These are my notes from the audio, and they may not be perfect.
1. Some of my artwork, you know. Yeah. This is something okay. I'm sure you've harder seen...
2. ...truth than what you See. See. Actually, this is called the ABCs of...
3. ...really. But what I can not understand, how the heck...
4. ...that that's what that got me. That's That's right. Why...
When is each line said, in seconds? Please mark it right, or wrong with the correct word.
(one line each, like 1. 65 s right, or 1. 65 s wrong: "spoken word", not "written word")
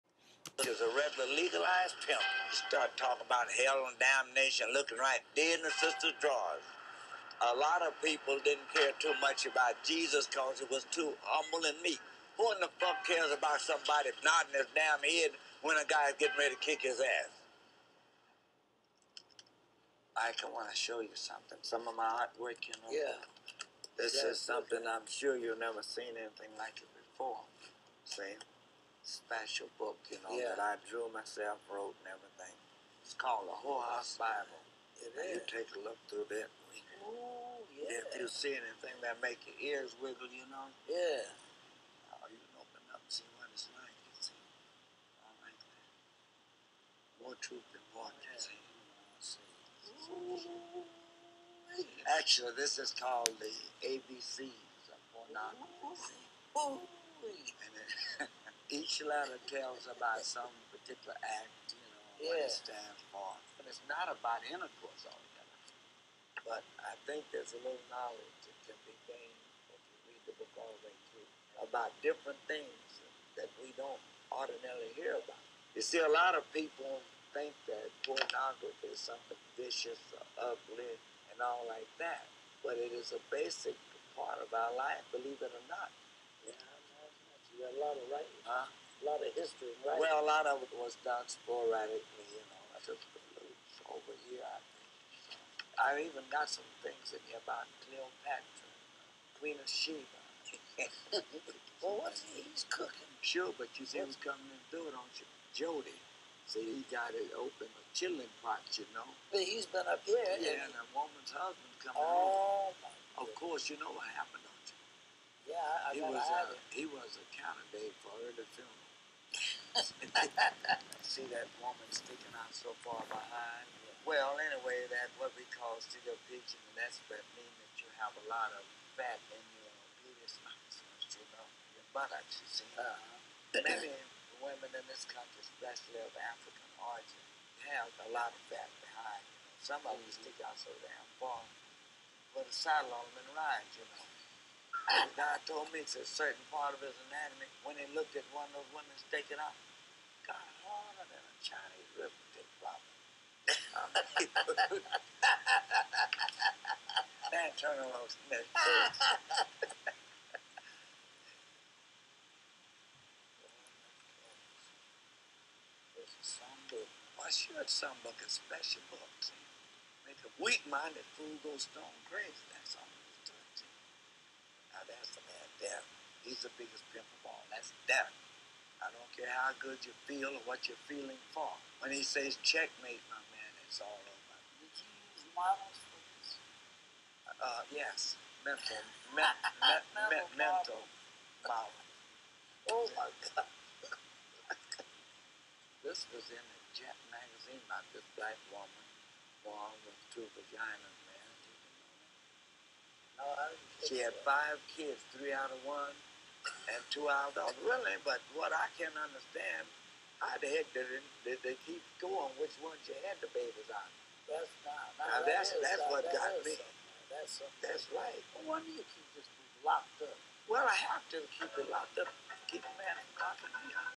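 1. 21 s wrong: "never", not "harder"
2. 47 s right
3. 207 s right
4. 215 s right.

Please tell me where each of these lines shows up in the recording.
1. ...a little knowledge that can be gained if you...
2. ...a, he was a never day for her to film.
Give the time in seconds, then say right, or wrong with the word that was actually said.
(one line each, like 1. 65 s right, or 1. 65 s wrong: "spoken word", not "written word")
1. 67 s right
2. 116 s wrong: "counter", not "never".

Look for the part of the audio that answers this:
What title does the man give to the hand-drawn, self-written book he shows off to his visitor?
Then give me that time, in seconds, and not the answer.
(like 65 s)
33 s.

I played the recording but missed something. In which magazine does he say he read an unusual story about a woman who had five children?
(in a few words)
Jet.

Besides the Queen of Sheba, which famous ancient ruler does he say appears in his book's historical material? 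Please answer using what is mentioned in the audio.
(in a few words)
Cleopatra.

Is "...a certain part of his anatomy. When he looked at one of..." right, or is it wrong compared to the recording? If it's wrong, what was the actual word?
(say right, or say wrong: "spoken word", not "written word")
right.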